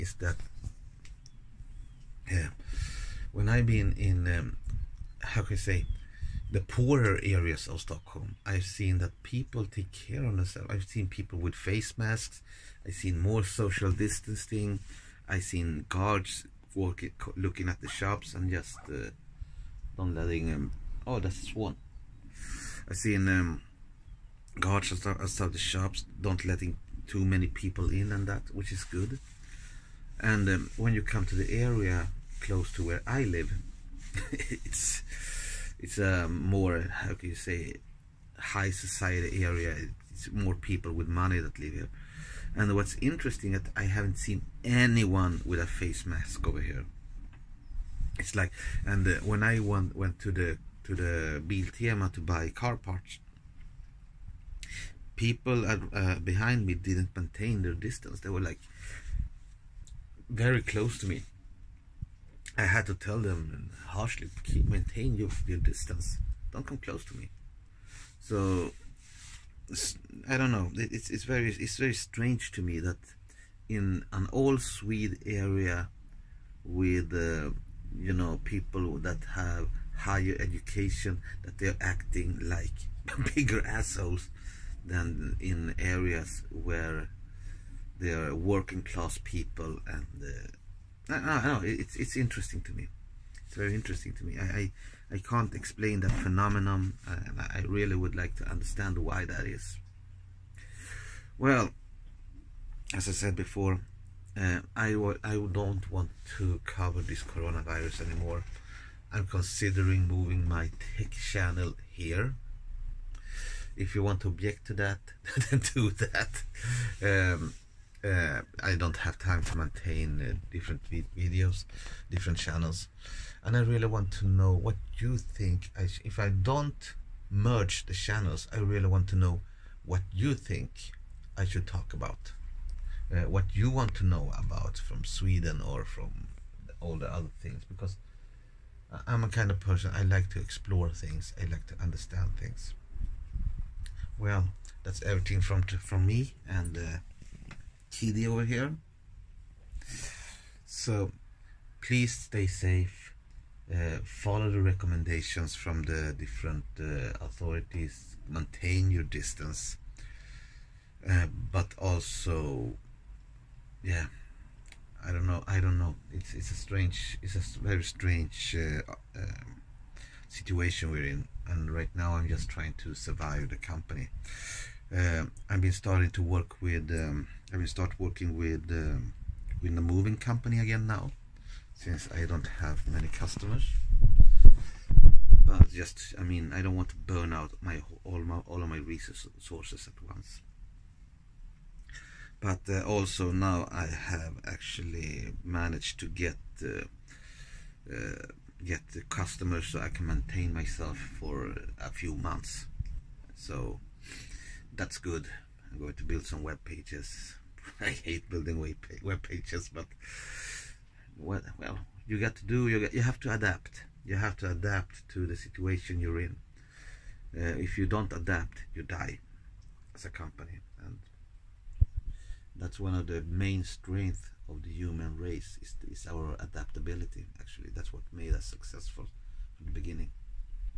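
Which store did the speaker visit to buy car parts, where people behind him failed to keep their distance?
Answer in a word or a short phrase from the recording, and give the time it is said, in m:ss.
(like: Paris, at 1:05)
Biltema, at 0:51.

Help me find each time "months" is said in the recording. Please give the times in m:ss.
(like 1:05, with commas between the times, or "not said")
3:22.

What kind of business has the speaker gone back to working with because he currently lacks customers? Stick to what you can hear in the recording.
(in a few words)
moving company.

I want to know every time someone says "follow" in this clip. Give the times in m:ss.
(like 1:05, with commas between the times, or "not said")
2:34.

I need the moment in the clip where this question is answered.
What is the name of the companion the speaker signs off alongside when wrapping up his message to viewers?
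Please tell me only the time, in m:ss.
2:27.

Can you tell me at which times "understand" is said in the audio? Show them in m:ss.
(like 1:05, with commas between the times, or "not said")
1:38, 2:21.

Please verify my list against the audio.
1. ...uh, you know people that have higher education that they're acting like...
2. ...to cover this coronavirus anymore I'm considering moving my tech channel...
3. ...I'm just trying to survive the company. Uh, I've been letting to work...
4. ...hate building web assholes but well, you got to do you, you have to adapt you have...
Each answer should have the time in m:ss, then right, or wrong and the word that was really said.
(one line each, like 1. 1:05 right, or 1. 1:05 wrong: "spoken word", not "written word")
1. 1:17 right
2. 1:46 right
3. 2:52 wrong: "starting", not "letting"
4. 3:28 wrong: "pages", not "assholes".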